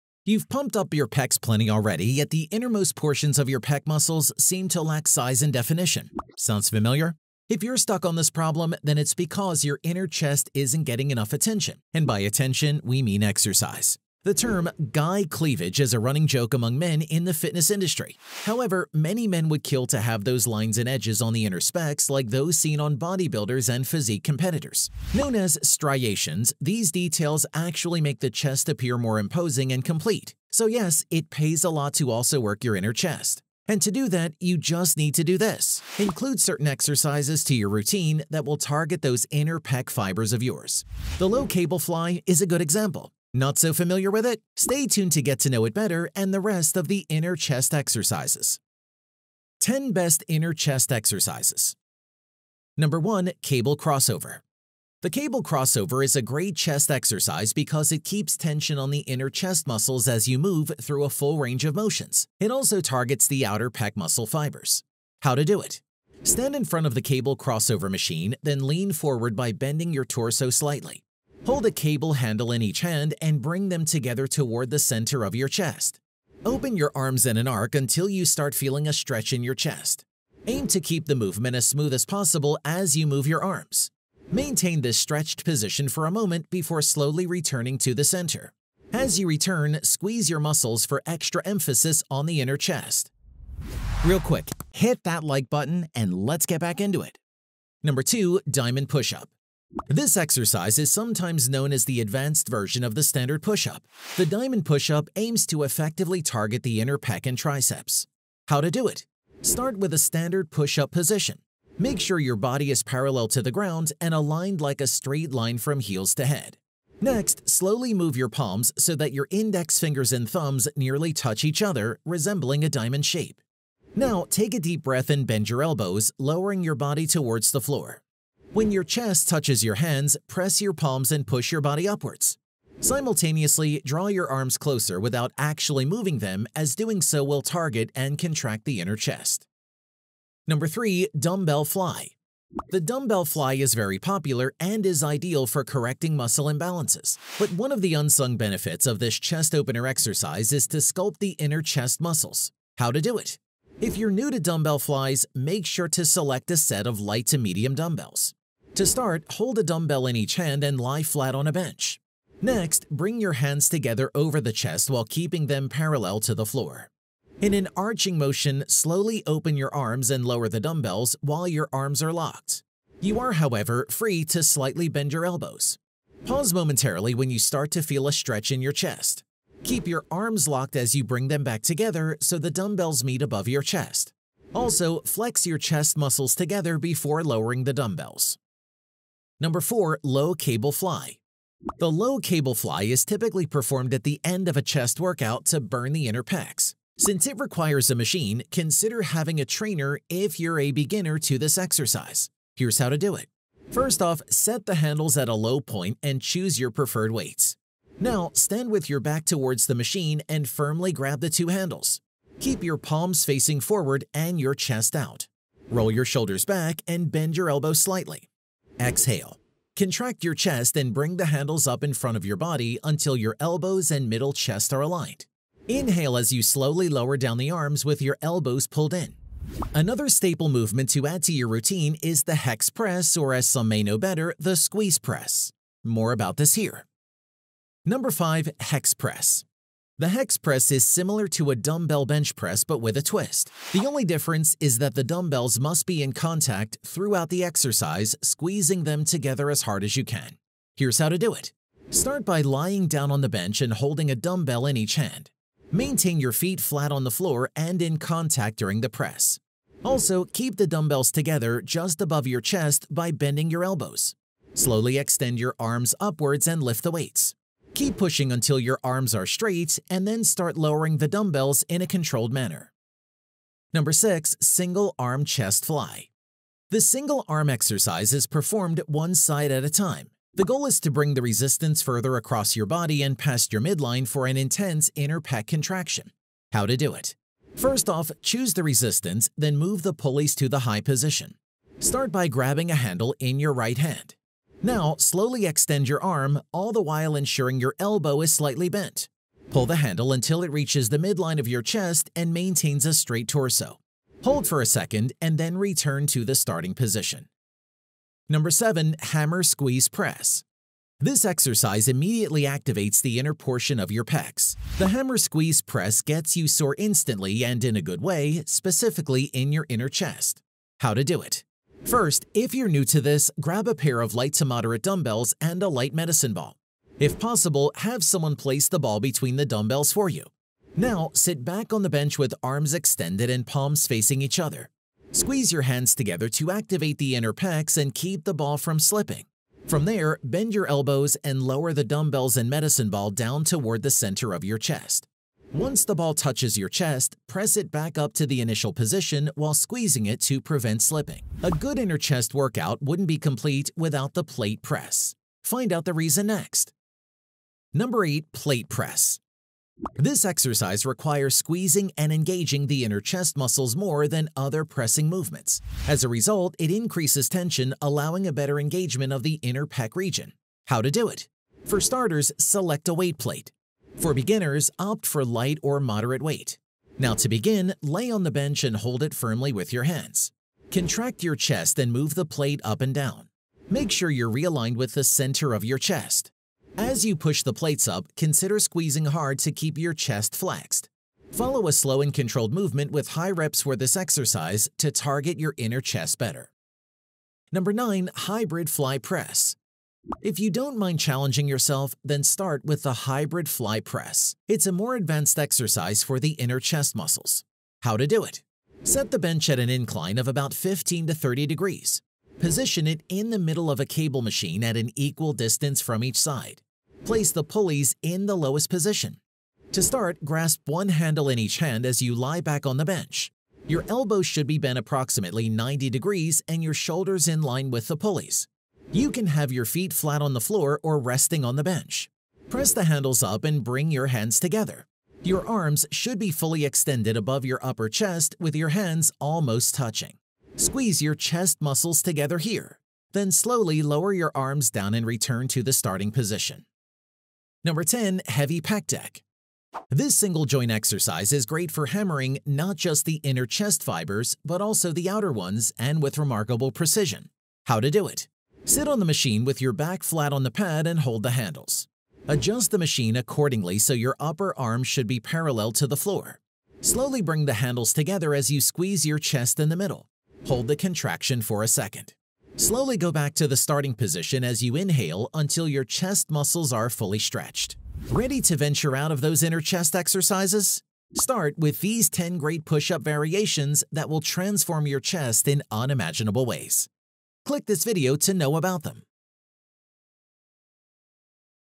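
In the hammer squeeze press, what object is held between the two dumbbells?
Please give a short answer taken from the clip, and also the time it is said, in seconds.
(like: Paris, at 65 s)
A light medicine ball, at 325 s.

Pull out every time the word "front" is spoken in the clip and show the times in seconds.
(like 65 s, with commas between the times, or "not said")
66 s, 221 s.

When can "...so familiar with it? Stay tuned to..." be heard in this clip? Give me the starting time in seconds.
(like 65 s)
43 s.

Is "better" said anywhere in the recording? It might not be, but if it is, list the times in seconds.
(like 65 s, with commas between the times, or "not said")
45 s, 233 s, 368 s, 396 s.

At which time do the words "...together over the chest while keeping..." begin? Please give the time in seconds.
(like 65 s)
163 s.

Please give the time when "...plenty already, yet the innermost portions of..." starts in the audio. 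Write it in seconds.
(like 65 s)
1 s.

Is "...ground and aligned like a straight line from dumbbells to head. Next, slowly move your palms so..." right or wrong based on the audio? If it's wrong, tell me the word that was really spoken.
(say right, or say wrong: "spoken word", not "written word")
wrong: "heels", not "dumbbells".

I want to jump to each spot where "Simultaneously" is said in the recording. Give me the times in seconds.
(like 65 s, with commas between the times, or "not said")
132 s.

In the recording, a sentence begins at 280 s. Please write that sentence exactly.
The goal is to bring the resistance further across your body and past your midline for an intense inner pec contraction.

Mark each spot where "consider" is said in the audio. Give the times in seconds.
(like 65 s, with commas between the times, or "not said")
198 s, 388 s.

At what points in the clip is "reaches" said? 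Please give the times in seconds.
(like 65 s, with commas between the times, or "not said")
300 s.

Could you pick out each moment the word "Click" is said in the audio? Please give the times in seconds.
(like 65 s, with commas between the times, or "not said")
487 s.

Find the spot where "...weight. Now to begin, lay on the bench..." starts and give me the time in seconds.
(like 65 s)
376 s.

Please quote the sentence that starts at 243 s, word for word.
The only difference is that the dumbbells must be in contact throughout the exercise, squeezing them together as hard as you can.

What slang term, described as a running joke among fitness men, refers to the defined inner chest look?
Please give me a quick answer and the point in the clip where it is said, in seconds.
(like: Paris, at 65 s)
Guy cleavage, at 14 s.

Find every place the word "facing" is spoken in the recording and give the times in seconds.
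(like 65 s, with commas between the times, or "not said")
213 s, 333 s.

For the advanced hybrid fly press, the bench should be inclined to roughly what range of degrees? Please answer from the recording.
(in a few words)
15 to 30 degrees.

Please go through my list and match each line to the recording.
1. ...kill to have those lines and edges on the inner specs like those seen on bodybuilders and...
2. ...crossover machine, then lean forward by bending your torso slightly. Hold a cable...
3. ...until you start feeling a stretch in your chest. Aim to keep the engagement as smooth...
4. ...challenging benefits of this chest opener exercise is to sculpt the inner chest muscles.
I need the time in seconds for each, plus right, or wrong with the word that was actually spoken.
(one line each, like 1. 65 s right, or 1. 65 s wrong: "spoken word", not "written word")
1. 19 s right
2. 67 s right
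3. 77 s wrong: "movement", not "engagement"
4. 147 s wrong: "unsung", not "challenging".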